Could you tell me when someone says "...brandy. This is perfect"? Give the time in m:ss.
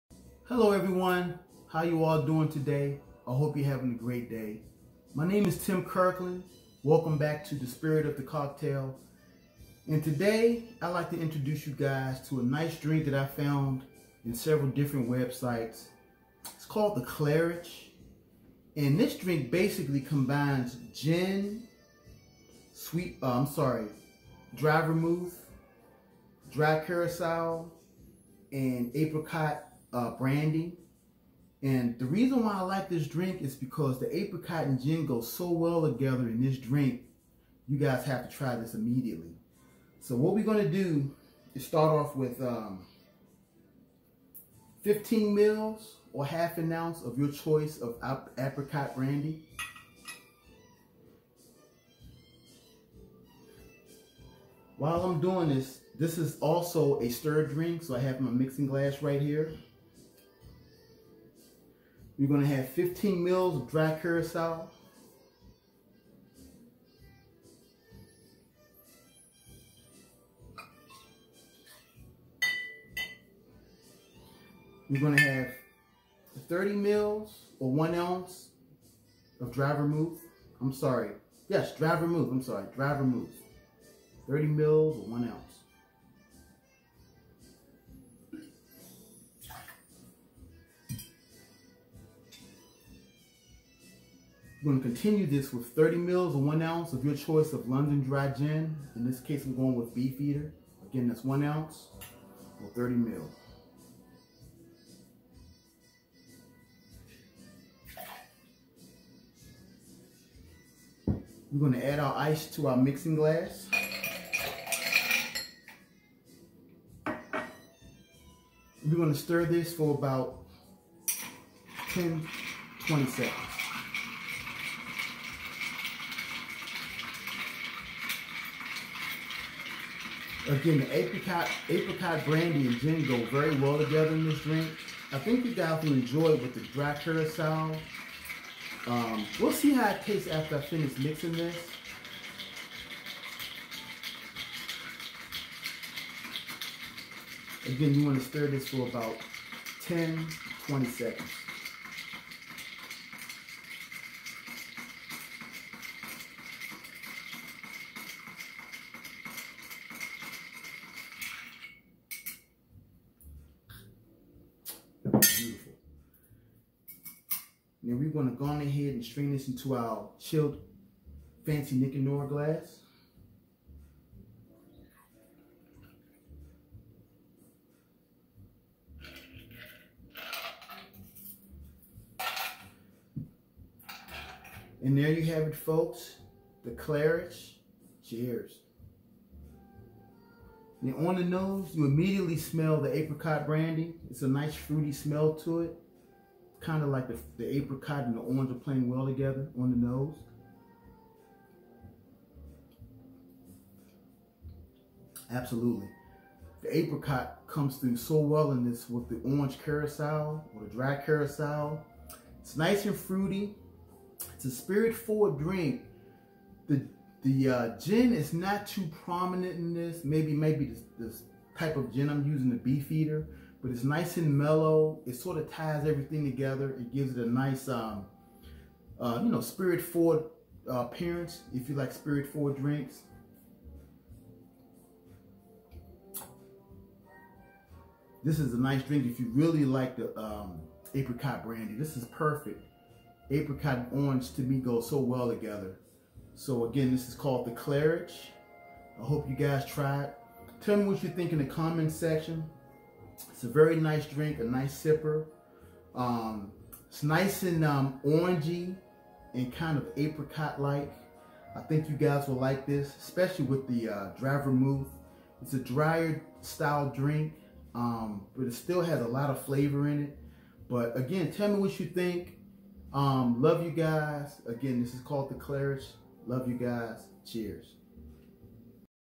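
4:01.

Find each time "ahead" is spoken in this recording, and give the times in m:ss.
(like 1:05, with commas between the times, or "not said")
2:48.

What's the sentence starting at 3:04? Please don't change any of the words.
And there you have it, folks.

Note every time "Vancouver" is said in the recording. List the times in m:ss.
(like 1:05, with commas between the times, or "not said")
not said.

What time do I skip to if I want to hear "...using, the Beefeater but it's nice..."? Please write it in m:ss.
3:42.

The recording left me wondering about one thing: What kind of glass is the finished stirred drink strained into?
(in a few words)
Nick and Nora glass.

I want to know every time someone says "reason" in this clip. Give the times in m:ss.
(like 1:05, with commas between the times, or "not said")
0:32.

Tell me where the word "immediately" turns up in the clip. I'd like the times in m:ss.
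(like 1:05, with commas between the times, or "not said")
0:38, 3:11.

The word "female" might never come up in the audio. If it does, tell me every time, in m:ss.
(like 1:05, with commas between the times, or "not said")
not said.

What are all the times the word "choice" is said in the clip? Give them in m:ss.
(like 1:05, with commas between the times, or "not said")
0:47, 1:37.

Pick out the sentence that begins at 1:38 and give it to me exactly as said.
In this case, I'm going with Beefeater.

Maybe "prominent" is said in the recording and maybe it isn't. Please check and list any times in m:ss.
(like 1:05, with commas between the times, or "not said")
3:39.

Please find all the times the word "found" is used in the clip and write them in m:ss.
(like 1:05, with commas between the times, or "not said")
0:13.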